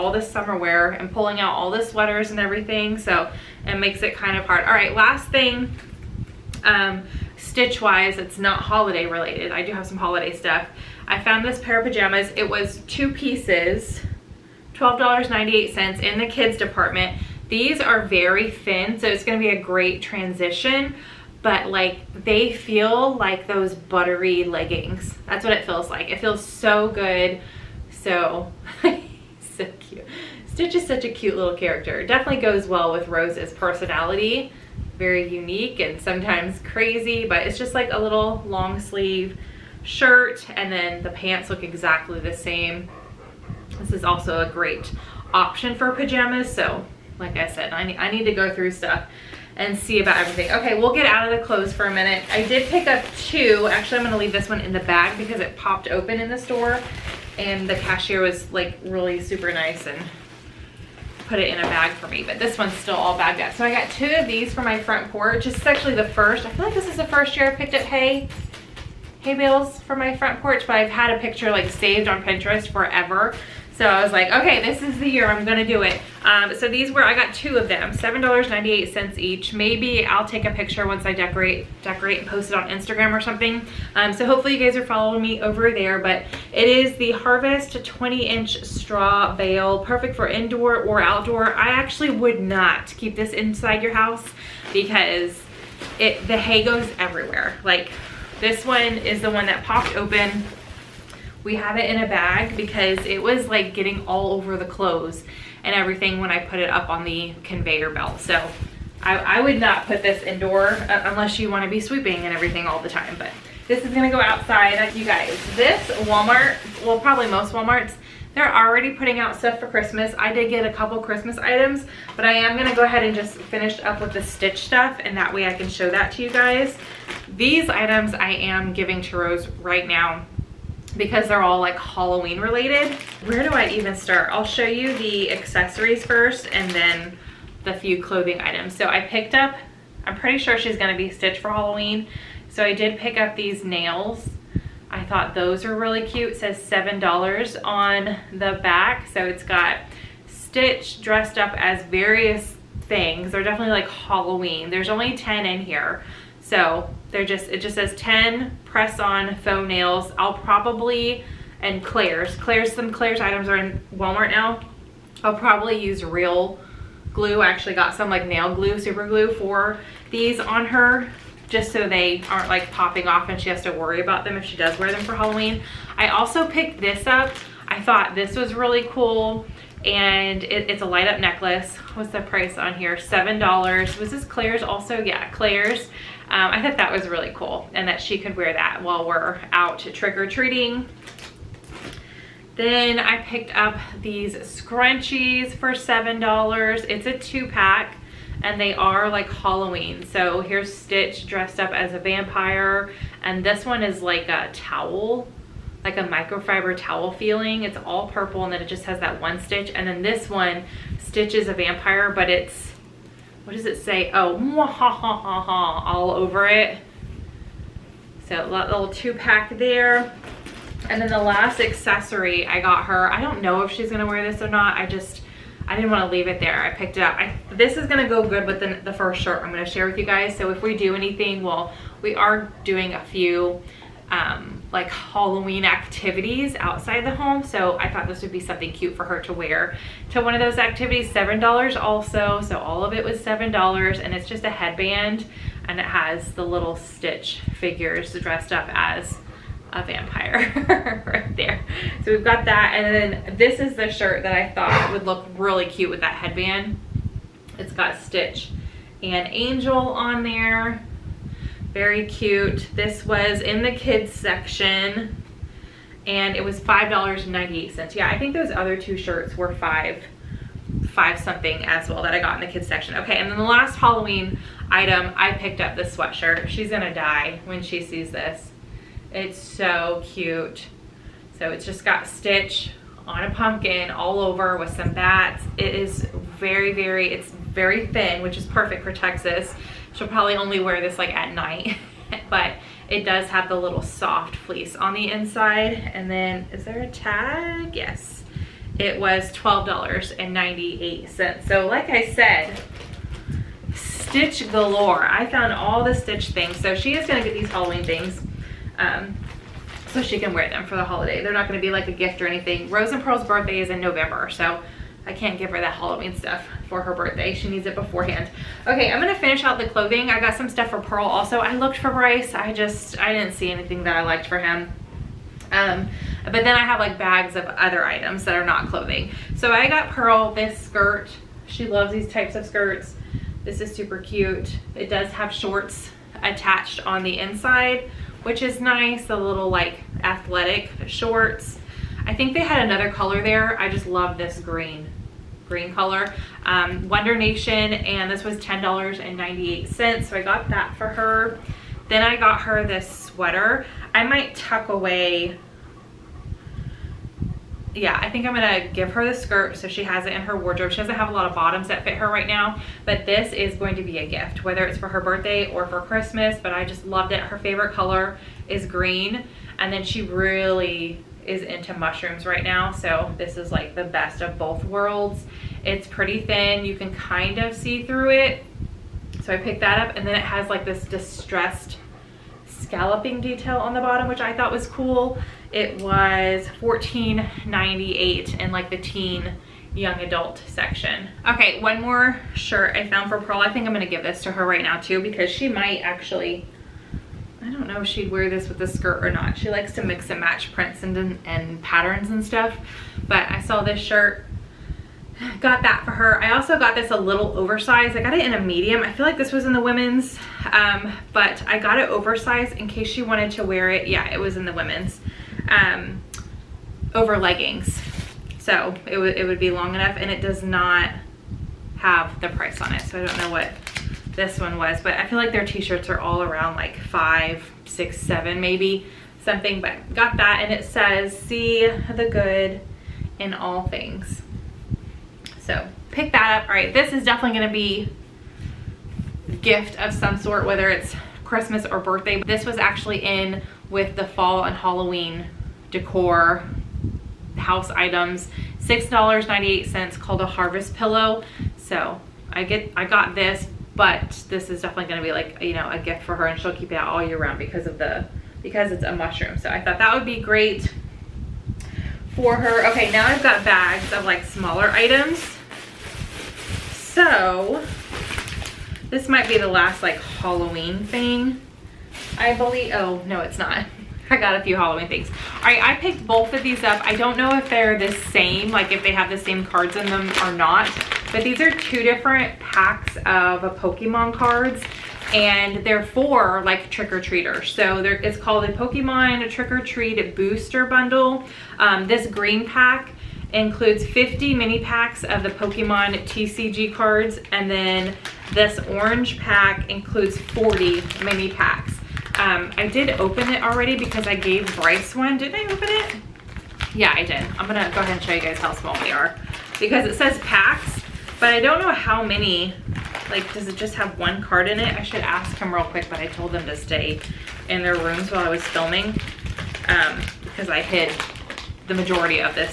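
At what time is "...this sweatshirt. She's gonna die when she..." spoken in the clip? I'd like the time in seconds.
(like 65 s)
275 s.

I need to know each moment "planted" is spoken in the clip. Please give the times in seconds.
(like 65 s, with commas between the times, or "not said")
not said.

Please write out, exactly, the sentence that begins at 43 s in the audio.
This is also a great option for pajamas.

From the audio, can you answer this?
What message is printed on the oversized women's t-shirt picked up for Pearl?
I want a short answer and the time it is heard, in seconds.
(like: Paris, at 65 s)
See the good in all things, at 431 s.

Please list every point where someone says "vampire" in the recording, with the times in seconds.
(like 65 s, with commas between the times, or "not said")
201 s, 211 s, 249 s.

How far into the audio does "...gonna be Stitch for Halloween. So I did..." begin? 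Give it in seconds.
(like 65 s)
140 s.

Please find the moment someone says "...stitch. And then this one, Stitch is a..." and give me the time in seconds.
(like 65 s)
209 s.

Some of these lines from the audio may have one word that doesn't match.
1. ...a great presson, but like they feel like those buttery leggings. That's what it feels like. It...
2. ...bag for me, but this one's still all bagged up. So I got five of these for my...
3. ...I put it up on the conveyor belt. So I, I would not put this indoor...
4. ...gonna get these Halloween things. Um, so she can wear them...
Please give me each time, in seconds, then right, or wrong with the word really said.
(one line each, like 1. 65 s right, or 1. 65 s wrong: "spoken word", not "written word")
1. 19 s wrong: "transition", not "presson"
2. 61 s wrong: "two", not "five"
3. 106 s right
4. 307 s right.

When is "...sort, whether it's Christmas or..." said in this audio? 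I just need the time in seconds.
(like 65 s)
440 s.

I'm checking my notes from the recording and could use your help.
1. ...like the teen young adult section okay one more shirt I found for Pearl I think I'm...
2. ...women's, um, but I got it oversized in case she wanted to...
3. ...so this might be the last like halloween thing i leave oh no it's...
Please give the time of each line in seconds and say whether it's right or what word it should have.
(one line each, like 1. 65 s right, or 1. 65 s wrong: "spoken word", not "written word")
1. 388 s right
2. 409 s right
3. 466 s wrong: "believe", not "leave".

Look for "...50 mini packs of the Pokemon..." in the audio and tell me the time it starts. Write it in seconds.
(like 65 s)
493 s.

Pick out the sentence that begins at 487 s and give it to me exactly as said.
So it's called a Pokemon Trick-or-Treat Booster Bundle.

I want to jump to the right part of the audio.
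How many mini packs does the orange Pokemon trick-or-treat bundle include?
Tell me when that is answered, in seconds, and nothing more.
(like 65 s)
500 s.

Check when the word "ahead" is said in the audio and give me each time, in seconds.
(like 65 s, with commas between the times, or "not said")
122 s, 507 s.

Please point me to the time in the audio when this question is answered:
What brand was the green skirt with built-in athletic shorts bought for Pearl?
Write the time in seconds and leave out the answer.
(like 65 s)
346 s.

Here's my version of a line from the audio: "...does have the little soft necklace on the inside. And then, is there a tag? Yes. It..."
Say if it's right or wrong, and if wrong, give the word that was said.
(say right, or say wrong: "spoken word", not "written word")
wrong: "fleece", not "necklace".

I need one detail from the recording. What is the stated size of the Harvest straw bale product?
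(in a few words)
20 inch.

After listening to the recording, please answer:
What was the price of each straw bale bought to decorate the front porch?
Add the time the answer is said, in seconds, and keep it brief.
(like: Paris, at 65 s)
$7.98, at 77 s.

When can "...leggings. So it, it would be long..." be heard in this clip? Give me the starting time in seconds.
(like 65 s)
417 s.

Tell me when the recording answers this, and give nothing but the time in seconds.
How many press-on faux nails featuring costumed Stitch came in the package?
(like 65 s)
157 s.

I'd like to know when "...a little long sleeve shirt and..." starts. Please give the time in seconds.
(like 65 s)
37 s.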